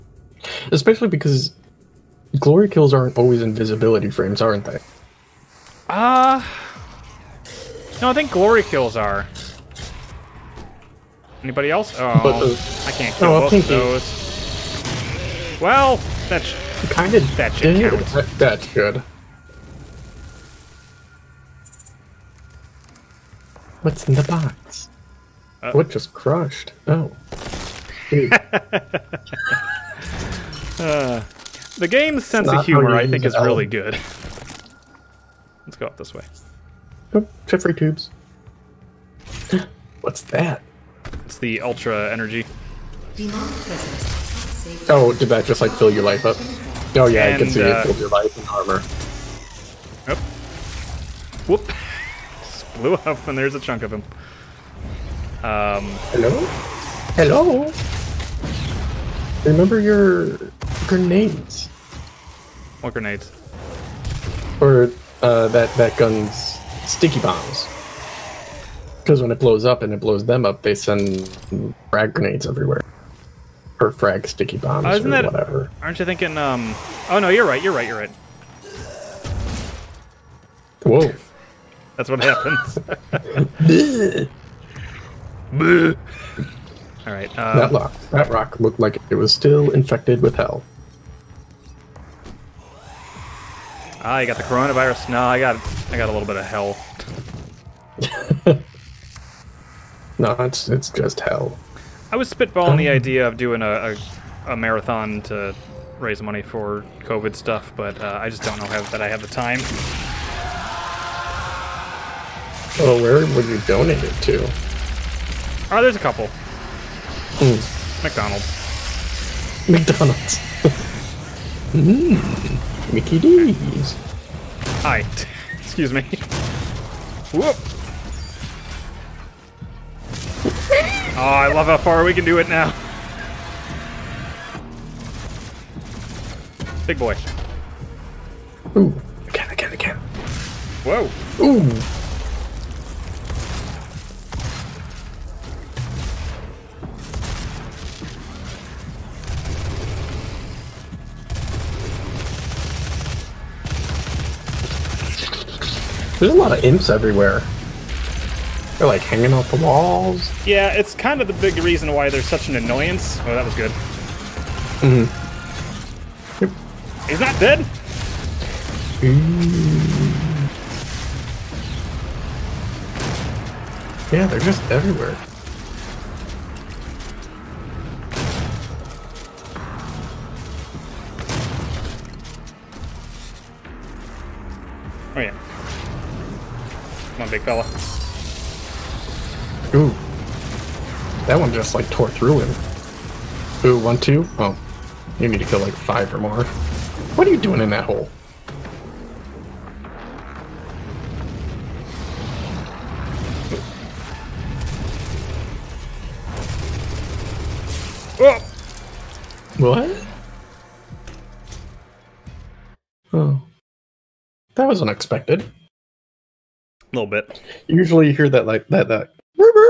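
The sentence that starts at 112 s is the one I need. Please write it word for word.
Oh, where would you donate it to?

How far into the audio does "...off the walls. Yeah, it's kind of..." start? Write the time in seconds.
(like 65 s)
159 s.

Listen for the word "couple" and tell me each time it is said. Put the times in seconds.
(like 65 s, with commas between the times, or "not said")
115 s.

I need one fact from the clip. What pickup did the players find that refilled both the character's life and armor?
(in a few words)
ultra energy.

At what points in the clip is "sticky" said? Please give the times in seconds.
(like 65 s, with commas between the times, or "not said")
66 s, 74 s.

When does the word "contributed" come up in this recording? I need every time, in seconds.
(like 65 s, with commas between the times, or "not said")
not said.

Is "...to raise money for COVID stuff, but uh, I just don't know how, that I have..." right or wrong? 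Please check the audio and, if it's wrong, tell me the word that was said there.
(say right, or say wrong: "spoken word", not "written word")
right.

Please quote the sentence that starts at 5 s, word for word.
Uh, no, I think glory kills are.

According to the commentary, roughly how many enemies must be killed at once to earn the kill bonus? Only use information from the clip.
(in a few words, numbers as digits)
5 or more.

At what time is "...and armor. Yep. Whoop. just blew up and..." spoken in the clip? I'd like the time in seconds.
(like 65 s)
48 s.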